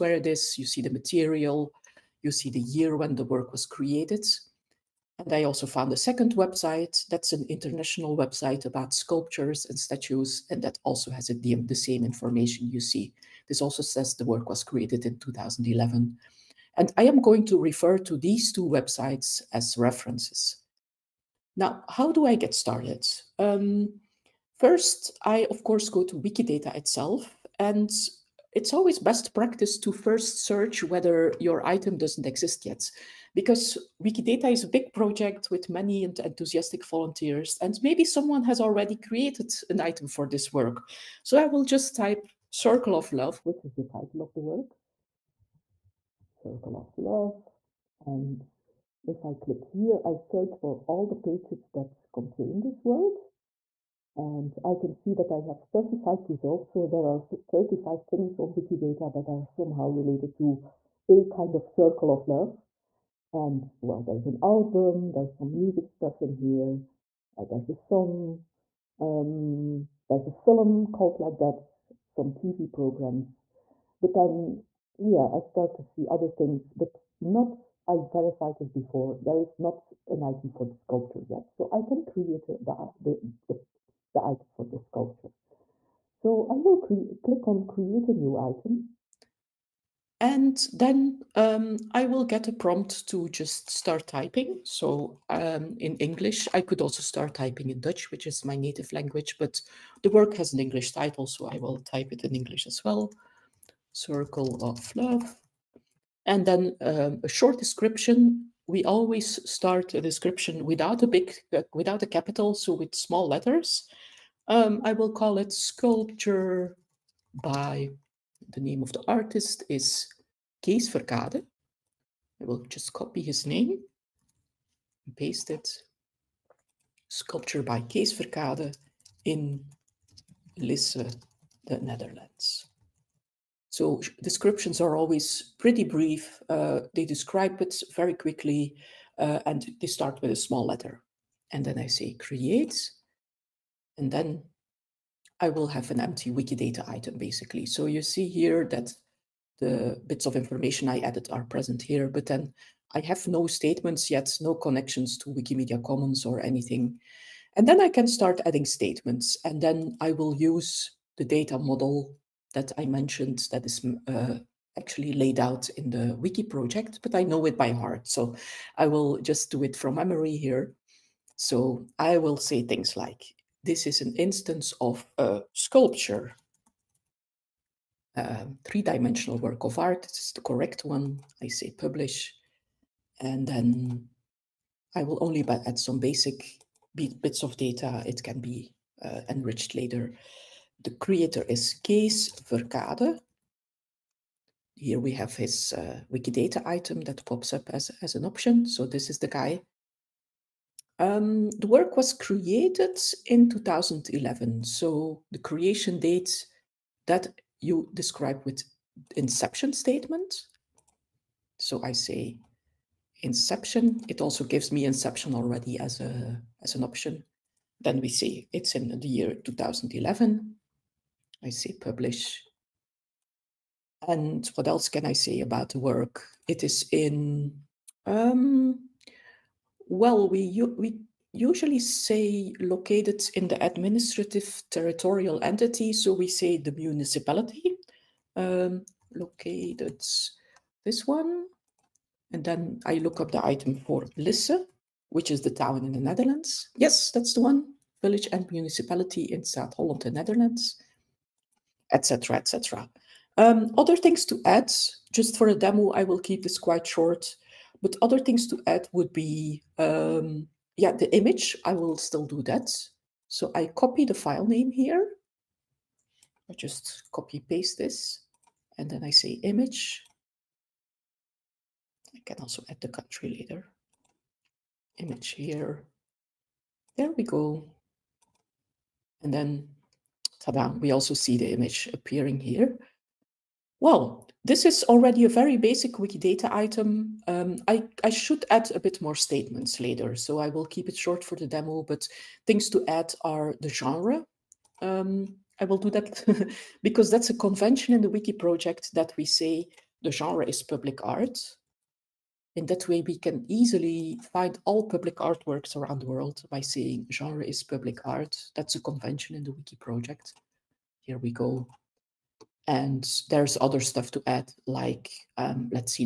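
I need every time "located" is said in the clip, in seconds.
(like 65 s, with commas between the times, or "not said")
232 s, 239 s.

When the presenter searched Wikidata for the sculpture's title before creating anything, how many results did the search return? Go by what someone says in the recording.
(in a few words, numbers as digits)
35.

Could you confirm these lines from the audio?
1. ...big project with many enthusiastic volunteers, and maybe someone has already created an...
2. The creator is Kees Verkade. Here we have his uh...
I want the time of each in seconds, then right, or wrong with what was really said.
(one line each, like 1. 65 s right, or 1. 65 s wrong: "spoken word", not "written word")
1. 34 s right
2. 190 s right.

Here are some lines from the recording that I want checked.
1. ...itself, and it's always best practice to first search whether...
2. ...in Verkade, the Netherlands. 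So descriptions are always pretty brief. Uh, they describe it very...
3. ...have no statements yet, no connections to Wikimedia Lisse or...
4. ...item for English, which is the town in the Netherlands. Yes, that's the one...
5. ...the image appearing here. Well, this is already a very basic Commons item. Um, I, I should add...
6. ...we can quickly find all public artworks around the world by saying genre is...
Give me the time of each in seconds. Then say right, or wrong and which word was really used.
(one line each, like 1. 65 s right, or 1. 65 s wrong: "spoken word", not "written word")
1. 26 s right
2. 129 s wrong: "Lisse", not "Verkade"
3. 153 s wrong: "Commons", not "Lisse"
4. 243 s wrong: "Lisse", not "English"
5. 281 s wrong: "Wikidata", not "Commons"
6. 303 s wrong: "easily", not "quickly".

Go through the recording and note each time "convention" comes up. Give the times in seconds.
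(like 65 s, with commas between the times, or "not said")
297 s, 308 s.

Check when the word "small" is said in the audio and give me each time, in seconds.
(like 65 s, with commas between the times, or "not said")
112 s, 140 s.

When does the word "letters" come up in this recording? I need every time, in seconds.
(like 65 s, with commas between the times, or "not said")
113 s, 140 s.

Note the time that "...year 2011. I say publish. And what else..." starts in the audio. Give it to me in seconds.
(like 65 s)
219 s.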